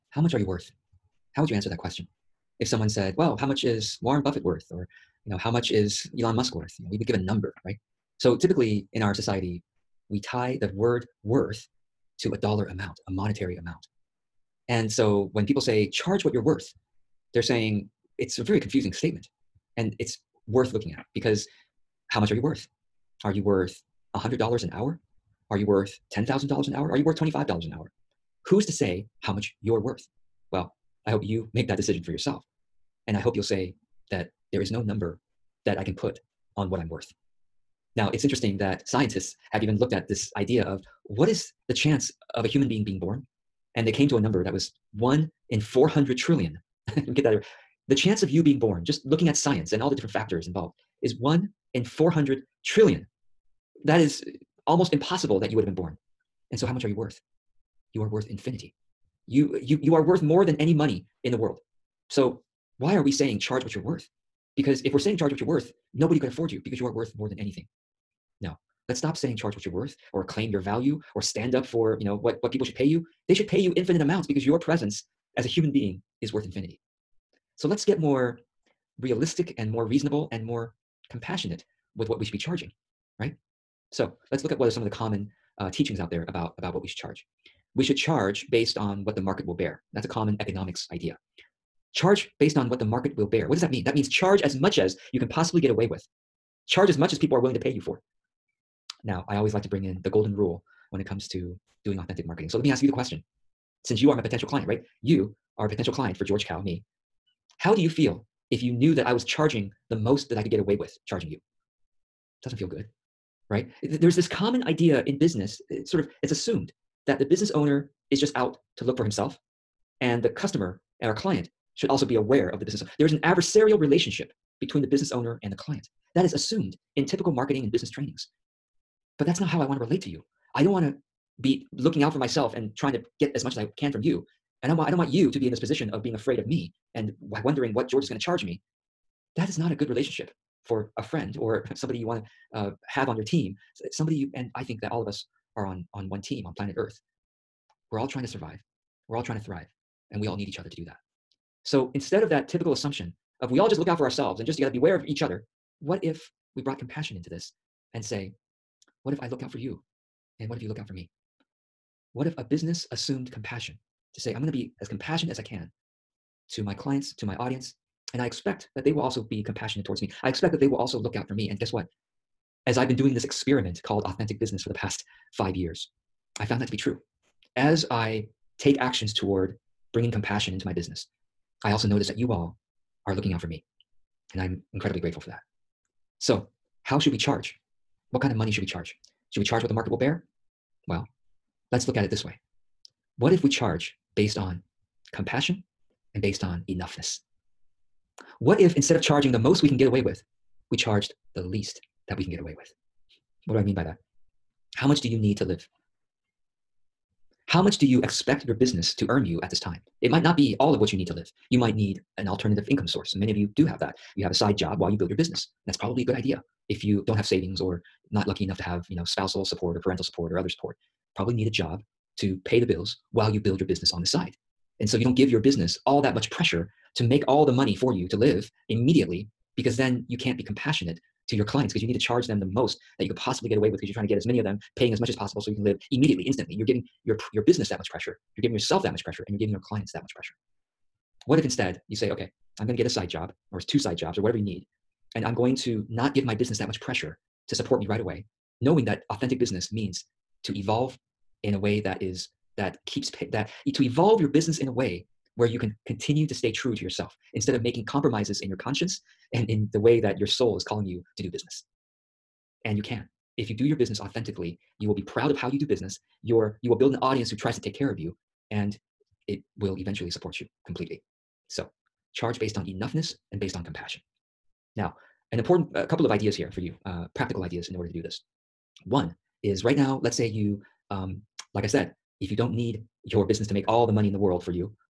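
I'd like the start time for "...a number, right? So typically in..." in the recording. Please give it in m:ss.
0:07.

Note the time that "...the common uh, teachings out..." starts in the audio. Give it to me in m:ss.
1:24.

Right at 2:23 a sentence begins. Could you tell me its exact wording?
Somebody you, and I think that all of us are on, on one team on planet Earth.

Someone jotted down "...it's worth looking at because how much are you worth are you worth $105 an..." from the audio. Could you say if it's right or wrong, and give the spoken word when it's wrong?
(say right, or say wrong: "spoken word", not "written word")
wrong: "100", not "105".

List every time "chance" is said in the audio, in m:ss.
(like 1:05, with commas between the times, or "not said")
0:41, 0:47.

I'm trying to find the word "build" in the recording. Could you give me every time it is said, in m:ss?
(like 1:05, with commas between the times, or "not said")
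3:34, 3:43, 4:26.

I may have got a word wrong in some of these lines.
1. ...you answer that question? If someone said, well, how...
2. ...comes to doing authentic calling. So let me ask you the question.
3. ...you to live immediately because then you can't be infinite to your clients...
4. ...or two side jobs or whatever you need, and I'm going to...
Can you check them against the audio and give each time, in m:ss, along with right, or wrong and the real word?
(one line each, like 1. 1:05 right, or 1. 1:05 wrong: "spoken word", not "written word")
1. 0:01 right
2. 1:41 wrong: "marketing", not "calling"
3. 3:47 wrong: "compassionate", not "infinite"
4. 4:03 right.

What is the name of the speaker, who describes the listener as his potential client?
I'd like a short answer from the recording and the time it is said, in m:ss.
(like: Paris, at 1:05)
George Kao, at 1:46.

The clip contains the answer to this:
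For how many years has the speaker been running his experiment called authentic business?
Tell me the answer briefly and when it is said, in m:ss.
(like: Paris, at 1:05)
5, at 2:55.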